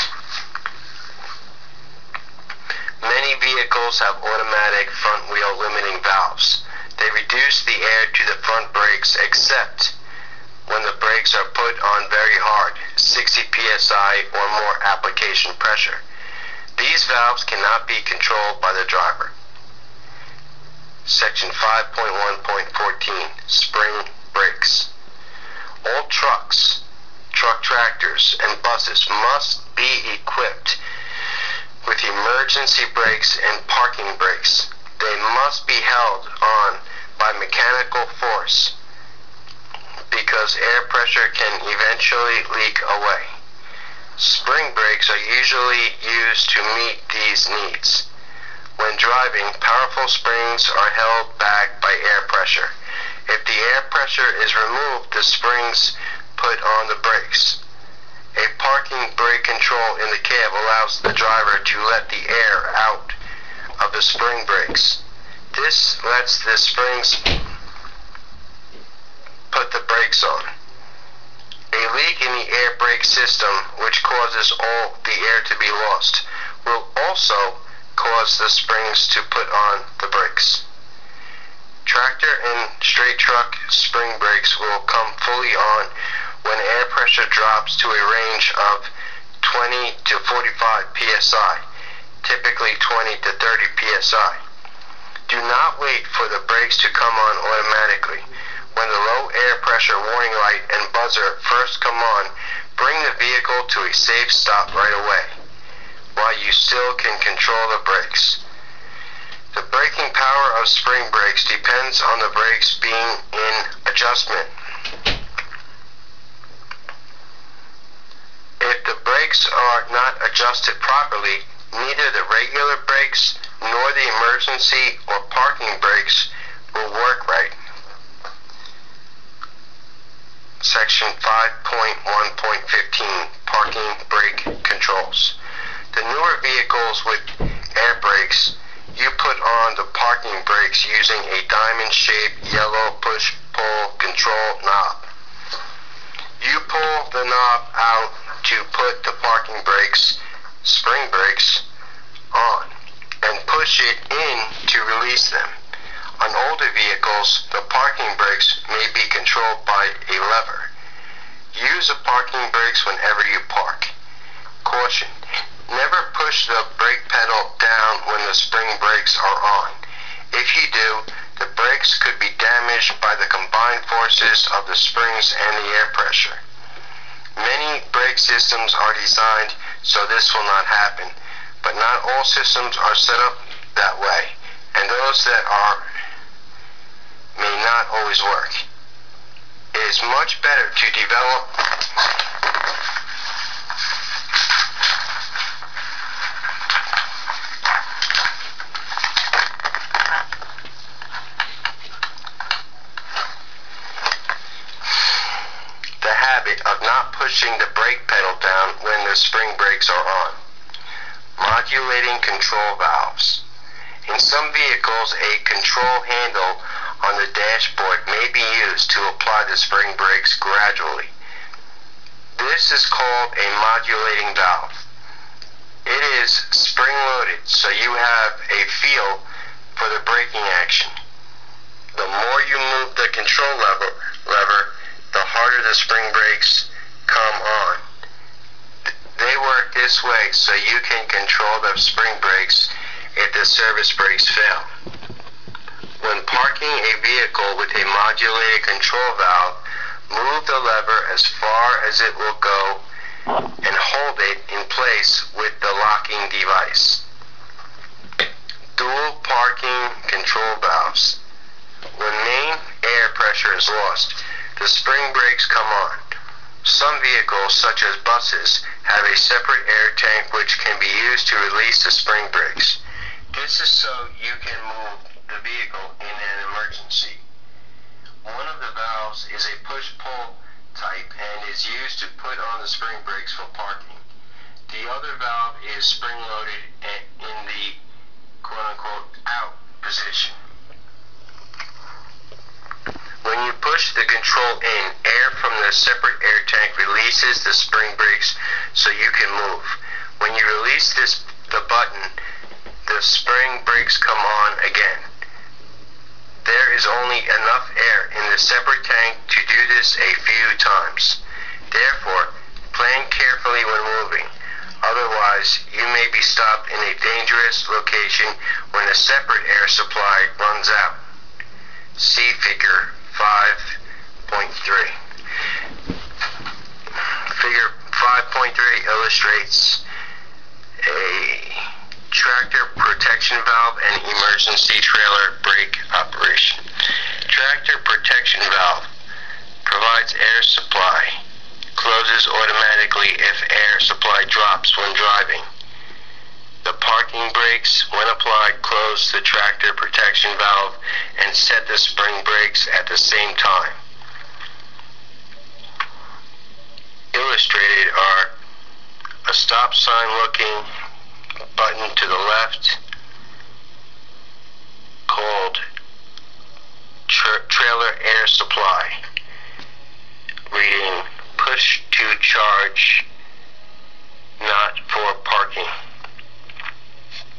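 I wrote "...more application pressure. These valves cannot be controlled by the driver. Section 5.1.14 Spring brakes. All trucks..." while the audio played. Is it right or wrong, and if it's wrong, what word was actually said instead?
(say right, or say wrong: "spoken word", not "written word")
right.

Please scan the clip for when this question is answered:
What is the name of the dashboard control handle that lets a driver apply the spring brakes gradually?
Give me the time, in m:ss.
3:43.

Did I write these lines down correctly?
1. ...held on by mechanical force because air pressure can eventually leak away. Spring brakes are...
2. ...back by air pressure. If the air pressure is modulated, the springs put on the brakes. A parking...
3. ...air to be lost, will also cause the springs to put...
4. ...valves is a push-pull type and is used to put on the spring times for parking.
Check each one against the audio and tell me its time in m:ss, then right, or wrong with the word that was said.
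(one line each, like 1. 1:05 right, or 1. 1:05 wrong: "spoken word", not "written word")
1. 0:35 right
2. 0:51 wrong: "removed", not "modulated"
3. 1:15 right
4. 4:38 wrong: "brakes", not "times".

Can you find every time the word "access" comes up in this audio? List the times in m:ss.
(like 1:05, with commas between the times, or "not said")
not said.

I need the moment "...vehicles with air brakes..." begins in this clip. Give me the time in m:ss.
2:16.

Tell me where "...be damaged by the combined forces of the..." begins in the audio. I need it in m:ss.
2:52.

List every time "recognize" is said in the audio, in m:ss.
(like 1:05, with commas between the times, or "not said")
not said.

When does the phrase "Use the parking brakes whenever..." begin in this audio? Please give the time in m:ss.
2:41.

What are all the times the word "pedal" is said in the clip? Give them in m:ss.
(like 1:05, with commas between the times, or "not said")
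2:47, 3:28.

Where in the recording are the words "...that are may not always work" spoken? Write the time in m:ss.
3:05.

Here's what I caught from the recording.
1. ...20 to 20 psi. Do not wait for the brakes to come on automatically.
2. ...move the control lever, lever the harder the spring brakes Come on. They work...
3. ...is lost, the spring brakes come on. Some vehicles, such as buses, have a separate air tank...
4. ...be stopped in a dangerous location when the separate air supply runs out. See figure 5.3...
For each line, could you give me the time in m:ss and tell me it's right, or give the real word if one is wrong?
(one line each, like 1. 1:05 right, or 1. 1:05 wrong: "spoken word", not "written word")
1. 1:32 wrong: "30", not "20"
2. 3:52 right
3. 4:23 right
4. 5:16 right.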